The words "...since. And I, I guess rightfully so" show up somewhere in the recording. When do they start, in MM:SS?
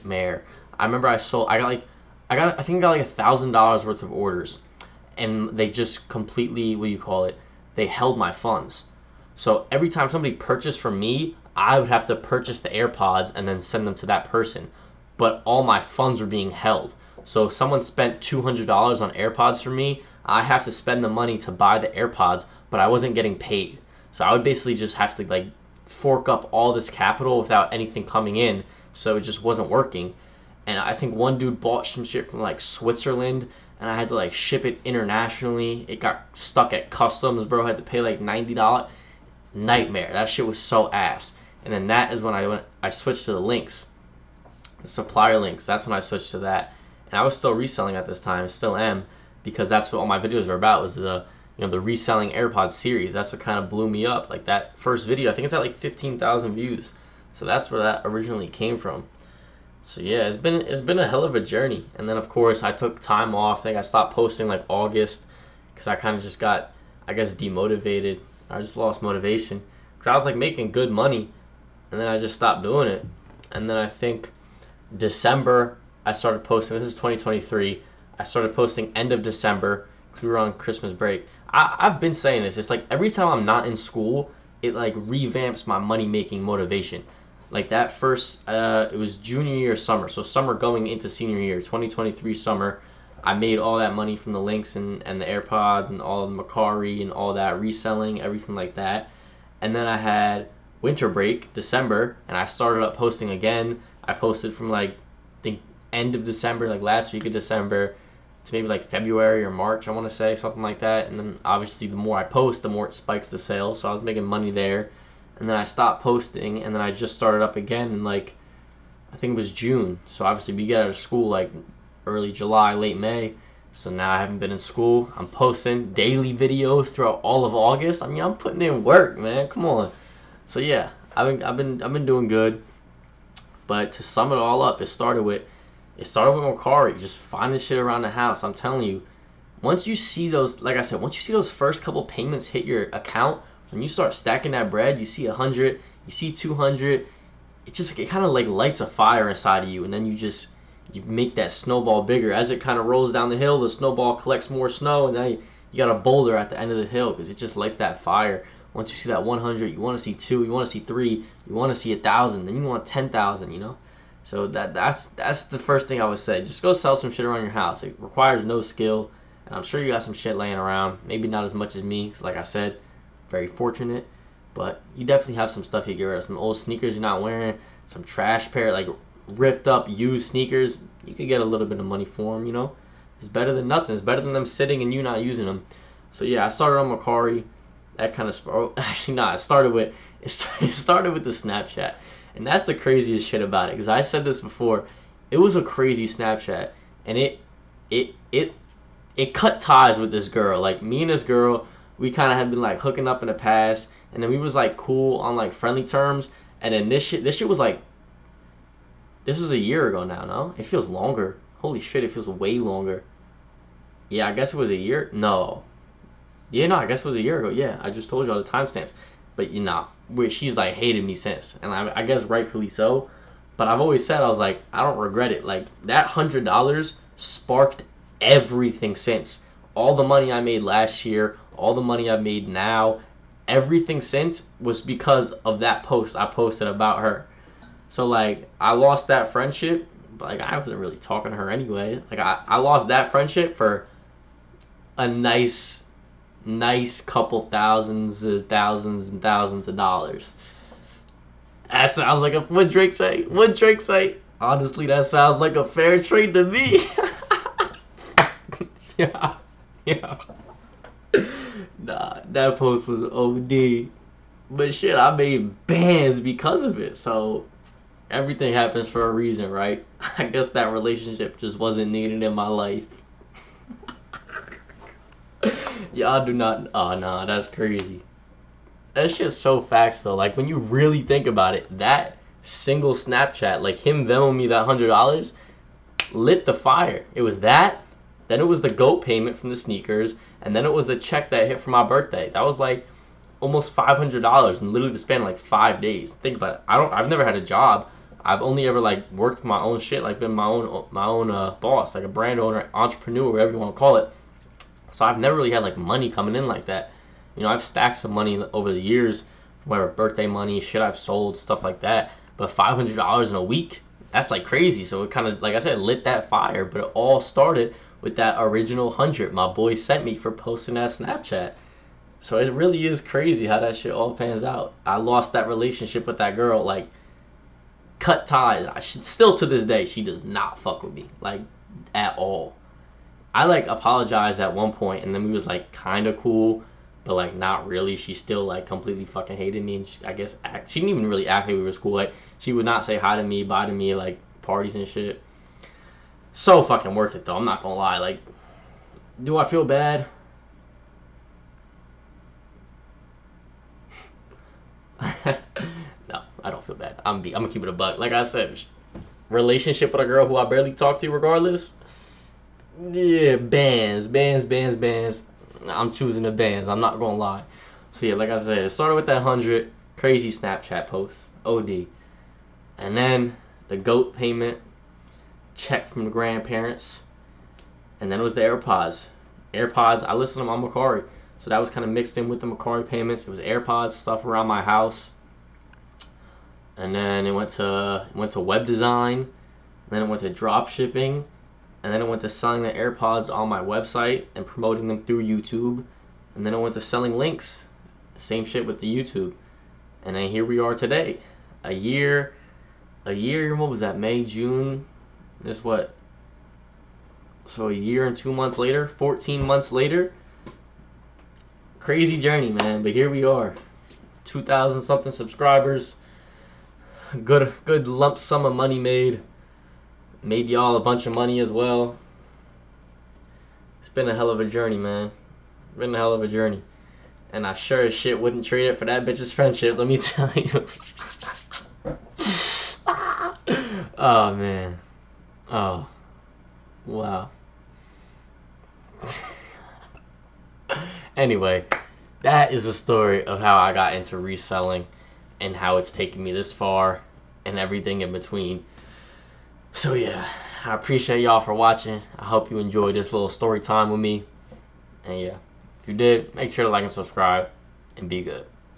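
03:41.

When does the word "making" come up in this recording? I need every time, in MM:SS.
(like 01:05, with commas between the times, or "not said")
01:10, 01:26, 01:54.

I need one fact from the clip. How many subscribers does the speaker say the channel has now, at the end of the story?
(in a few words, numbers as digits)
2,000.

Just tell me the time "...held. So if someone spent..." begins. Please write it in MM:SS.
00:16.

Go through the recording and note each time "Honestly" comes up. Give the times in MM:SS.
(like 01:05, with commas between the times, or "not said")
04:14.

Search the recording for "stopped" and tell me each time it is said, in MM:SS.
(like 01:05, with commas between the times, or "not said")
01:03, 01:12, 01:55.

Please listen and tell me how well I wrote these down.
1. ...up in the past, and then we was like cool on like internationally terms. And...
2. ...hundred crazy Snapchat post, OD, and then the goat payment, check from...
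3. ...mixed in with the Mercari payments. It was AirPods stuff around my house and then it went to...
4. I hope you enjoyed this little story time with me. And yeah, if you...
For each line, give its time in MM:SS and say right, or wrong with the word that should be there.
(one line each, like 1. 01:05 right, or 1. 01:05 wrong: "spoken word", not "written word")
1. 03:23 wrong: "friendly", not "internationally"
2. 06:09 right
3. 06:21 right
4. 07:32 right.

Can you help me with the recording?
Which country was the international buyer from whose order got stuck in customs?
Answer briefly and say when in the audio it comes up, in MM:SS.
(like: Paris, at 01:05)
Switzerland, at 00:32.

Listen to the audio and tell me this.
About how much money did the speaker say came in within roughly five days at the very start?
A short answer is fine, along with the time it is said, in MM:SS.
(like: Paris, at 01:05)
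$500, at 04:53.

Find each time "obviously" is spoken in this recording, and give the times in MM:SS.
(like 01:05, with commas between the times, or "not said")
01:51, 02:00.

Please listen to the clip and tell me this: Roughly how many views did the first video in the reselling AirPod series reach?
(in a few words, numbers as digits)
15,000.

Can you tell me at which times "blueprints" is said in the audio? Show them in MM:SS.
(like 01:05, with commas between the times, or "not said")
not said.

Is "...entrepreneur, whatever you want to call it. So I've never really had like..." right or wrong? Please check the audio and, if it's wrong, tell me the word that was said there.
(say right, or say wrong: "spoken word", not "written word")
right.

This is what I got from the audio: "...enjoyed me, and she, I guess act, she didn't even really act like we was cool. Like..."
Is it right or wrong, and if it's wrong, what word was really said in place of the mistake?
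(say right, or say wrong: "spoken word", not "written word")
wrong: "hated", not "enjoyed".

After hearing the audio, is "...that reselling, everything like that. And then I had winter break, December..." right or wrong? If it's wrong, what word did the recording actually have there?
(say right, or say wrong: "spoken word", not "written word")
right.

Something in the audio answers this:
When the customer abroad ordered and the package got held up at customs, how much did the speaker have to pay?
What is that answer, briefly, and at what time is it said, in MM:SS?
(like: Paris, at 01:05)
$90, at 00:38.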